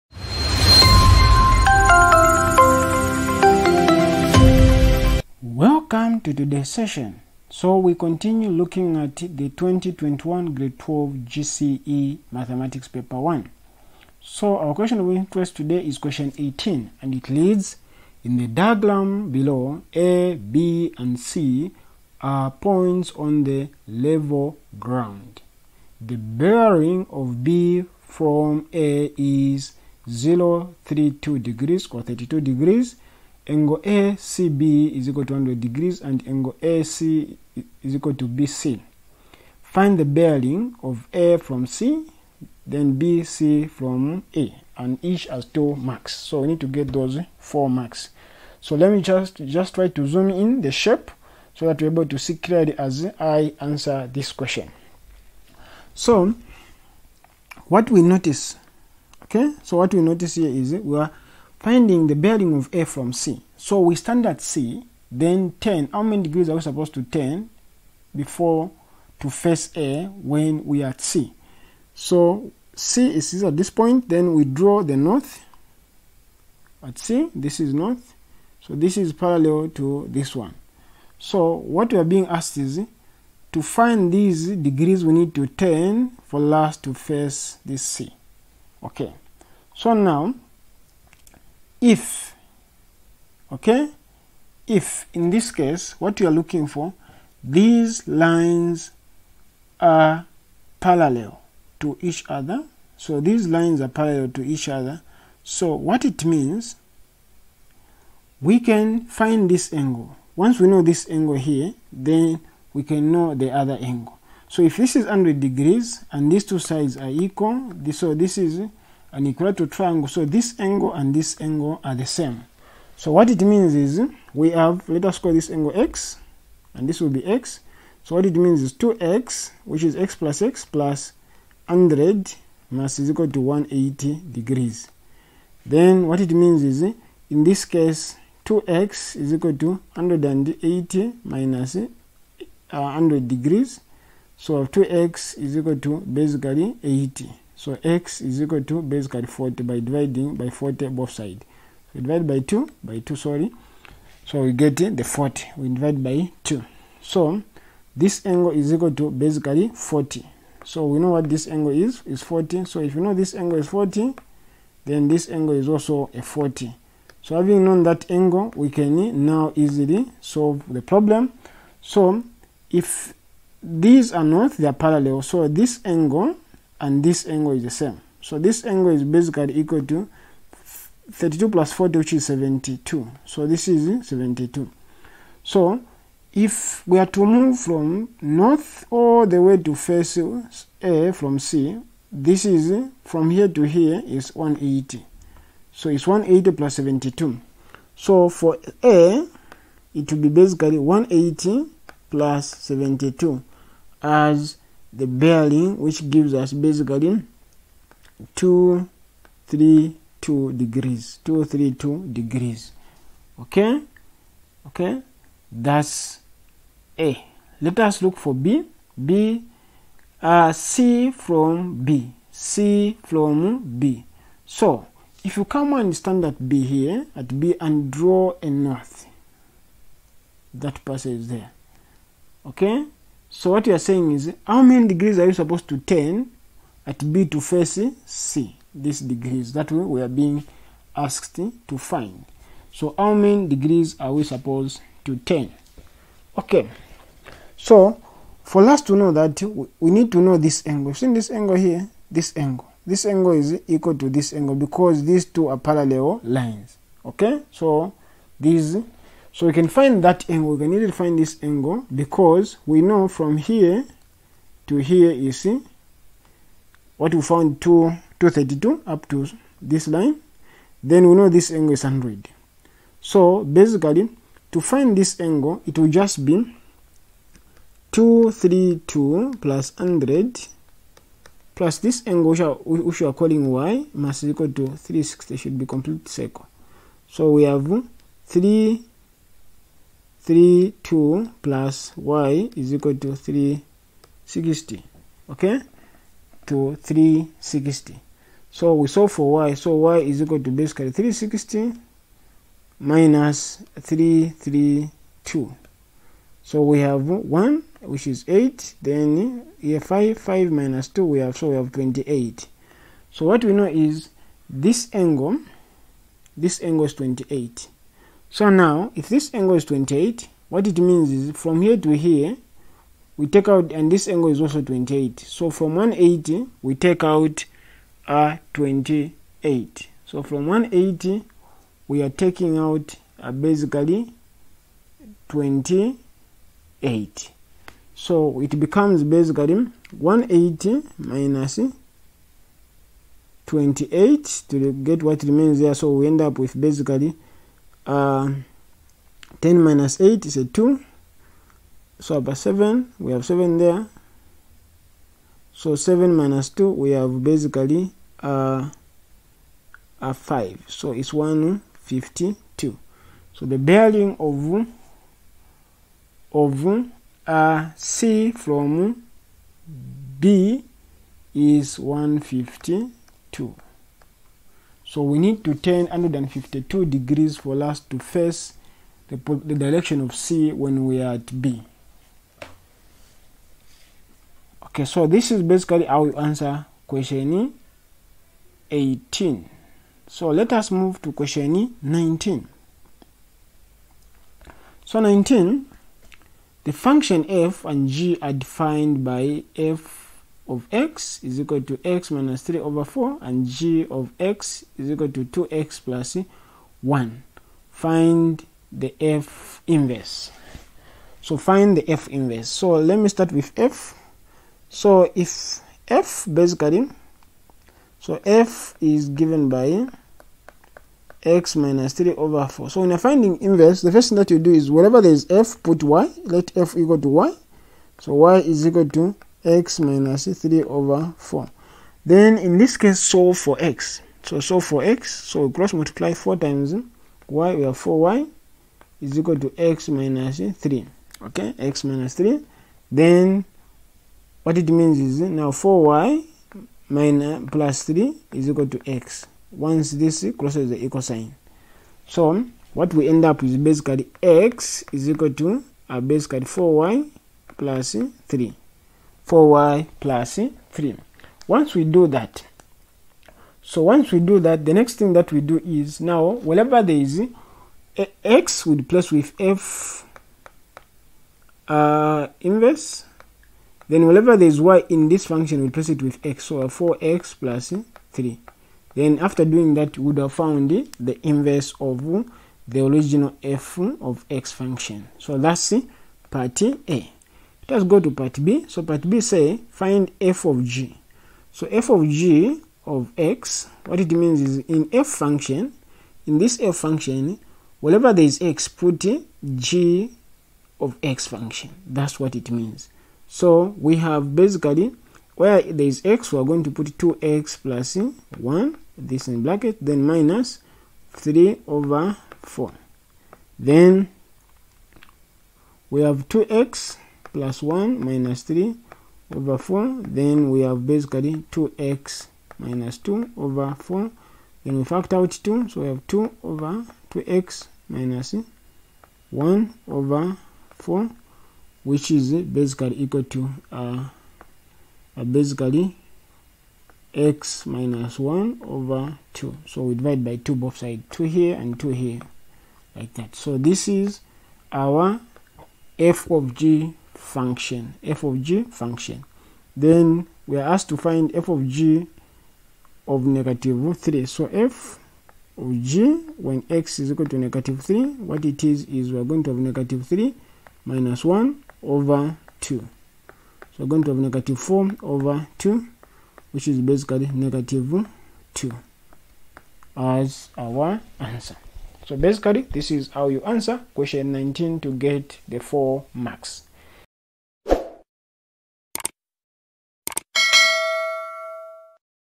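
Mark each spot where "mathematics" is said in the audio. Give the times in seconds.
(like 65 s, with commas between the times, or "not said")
12 s.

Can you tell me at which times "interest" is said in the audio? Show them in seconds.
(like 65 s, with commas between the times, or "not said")
15 s.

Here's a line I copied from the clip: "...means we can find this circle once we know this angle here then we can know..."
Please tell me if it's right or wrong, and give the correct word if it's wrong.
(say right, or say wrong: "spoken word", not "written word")
wrong: "angle", not "circle".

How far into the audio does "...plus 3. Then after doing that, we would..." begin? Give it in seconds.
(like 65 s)
477 s.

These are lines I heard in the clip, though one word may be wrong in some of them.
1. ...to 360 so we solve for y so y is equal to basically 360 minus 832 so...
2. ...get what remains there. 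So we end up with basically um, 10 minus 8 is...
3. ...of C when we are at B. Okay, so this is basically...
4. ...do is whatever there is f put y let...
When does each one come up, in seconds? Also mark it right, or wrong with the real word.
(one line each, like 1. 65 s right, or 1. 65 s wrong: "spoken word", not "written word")
1. 296 s wrong: "332", not "832"
2. 344 s right
3. 380 s right
4. 424 s wrong: "wherever", not "whatever".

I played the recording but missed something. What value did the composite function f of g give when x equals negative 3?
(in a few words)
-2.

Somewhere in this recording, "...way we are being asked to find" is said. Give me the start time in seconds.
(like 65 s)
239 s.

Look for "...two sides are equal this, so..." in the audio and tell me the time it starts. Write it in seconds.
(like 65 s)
116 s.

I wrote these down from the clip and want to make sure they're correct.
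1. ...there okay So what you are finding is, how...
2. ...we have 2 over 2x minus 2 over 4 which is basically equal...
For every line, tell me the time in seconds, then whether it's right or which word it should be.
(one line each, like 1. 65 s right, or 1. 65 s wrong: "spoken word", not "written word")
1. 231 s wrong: "saying", not "finding"
2. 525 s wrong: "1", not "2".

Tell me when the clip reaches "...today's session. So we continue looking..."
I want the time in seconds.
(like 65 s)
6 s.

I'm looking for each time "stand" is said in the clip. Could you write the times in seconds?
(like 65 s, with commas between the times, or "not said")
63 s, 225 s.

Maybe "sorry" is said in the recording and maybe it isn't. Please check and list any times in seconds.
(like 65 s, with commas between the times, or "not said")
153 s.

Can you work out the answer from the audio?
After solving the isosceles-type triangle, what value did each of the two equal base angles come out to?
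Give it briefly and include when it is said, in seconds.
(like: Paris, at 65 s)
40, at 147 s.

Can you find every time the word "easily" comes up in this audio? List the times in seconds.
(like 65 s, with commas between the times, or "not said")
169 s, 260 s.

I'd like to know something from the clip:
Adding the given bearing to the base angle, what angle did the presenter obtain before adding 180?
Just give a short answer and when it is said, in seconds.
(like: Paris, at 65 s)
72, at 181 s.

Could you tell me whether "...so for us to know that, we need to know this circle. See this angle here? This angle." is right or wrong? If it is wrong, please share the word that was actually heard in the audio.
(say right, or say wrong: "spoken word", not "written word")
wrong: "angle", not "circle".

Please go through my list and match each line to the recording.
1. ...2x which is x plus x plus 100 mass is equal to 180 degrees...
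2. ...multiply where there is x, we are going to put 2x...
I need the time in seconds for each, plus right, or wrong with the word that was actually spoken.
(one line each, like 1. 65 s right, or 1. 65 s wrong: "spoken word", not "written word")
1. 128 s right
2. 504 s wrong: "basically", not "multiply".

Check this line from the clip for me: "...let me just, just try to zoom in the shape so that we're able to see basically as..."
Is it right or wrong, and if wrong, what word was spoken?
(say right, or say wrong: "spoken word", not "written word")
wrong: "clearly", not "basically".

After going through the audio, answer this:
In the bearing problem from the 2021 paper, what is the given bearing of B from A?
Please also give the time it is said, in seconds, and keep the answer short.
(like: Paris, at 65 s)
032 degrees, at 30 s.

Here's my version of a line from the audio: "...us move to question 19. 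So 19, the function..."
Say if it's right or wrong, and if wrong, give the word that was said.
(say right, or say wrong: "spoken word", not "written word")
right.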